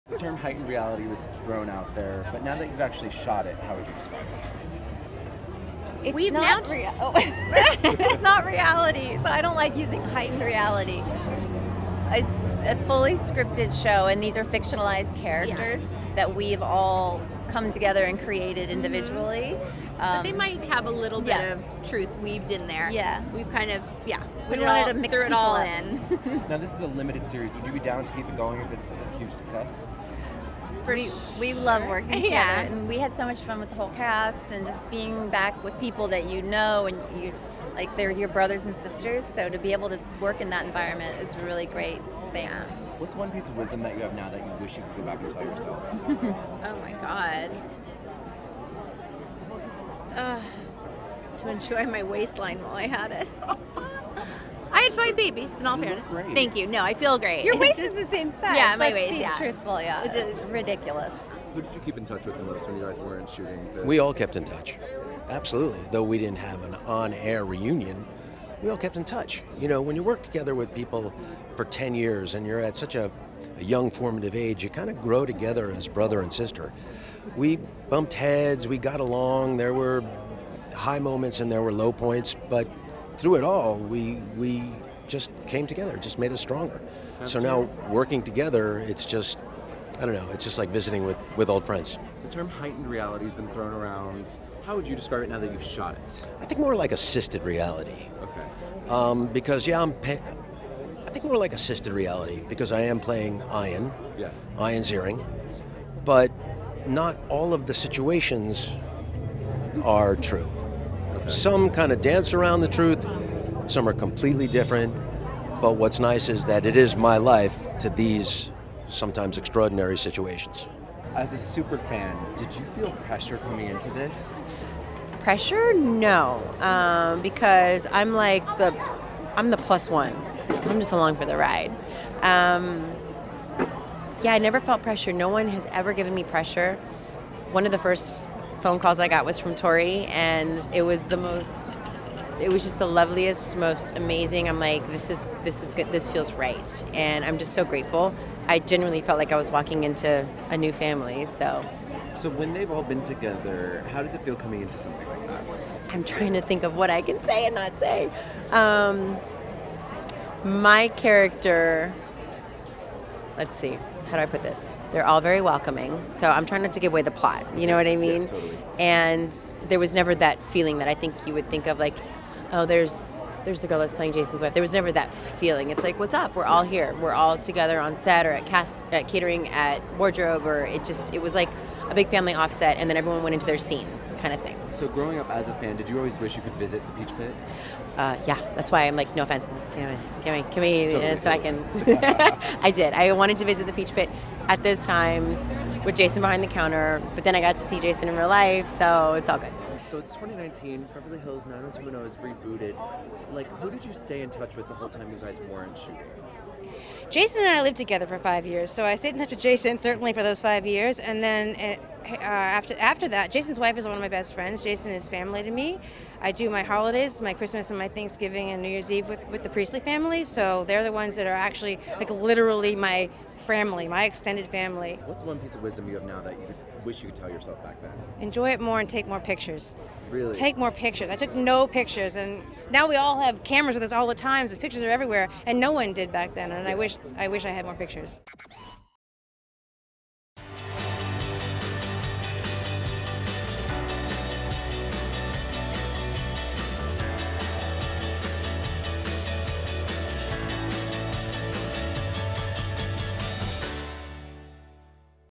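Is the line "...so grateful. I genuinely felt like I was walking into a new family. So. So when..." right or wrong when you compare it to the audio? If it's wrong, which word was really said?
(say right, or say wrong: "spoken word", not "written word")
right.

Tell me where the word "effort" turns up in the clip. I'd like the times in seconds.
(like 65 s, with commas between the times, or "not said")
not said.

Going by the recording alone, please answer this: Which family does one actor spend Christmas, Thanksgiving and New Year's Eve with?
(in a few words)
The Priestley family.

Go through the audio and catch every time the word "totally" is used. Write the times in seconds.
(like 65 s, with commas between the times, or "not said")
168 s, 190 s.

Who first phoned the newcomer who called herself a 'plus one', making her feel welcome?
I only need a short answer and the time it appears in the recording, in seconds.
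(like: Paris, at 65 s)
Tori, at 139 s.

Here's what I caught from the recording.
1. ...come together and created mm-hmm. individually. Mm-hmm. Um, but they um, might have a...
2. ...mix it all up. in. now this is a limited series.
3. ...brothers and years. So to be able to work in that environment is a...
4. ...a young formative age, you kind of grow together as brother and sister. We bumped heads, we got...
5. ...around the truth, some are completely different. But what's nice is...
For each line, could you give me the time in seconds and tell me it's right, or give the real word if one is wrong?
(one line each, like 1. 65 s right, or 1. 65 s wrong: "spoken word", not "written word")
1. 17 s right
2. 24 s right
3. 38 s wrong: "sisters", not "years"
4. 73 s right
5. 112 s right.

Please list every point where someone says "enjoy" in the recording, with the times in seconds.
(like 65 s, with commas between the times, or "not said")
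51 s, 228 s.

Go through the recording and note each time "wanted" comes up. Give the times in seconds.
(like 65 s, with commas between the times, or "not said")
24 s, 193 s.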